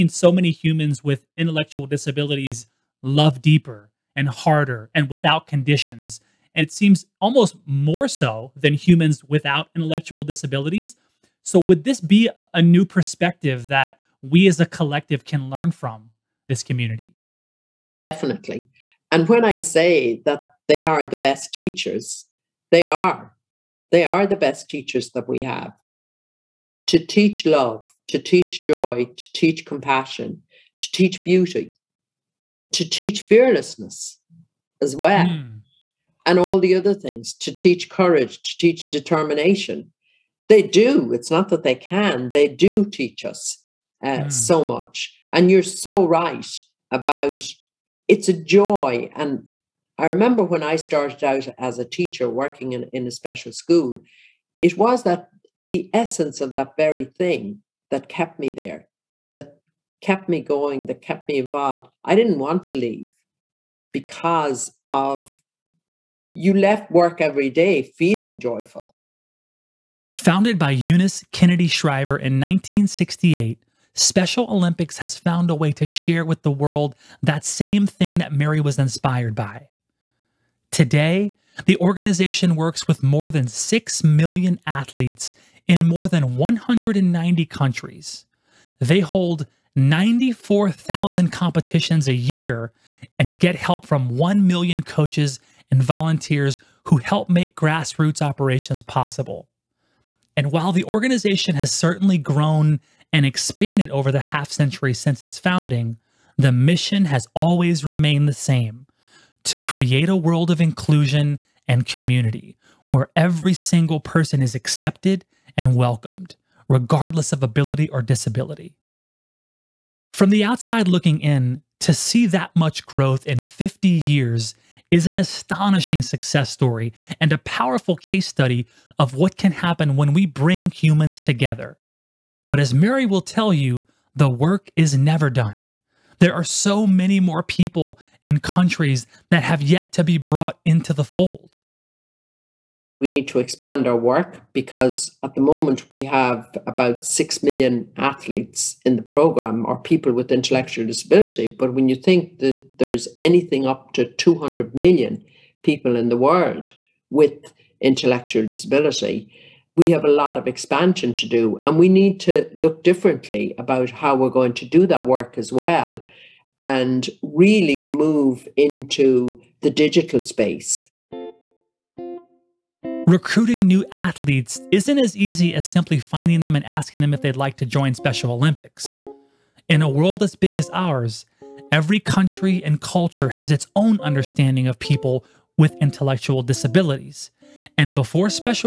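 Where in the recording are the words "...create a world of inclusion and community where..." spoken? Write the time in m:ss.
1:49.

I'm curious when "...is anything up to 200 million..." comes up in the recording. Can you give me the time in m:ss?
2:32.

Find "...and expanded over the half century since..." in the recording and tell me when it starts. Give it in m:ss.
1:43.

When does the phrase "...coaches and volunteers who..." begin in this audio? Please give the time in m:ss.
1:34.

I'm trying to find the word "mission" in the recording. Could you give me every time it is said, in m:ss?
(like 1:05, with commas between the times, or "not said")
1:46.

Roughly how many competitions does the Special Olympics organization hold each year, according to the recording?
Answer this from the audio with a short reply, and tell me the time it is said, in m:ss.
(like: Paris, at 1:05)
94,000, at 1:29.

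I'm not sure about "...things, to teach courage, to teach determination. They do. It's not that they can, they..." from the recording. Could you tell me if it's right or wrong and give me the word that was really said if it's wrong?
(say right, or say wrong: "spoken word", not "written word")
right.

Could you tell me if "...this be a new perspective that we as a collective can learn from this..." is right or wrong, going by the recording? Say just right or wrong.
right.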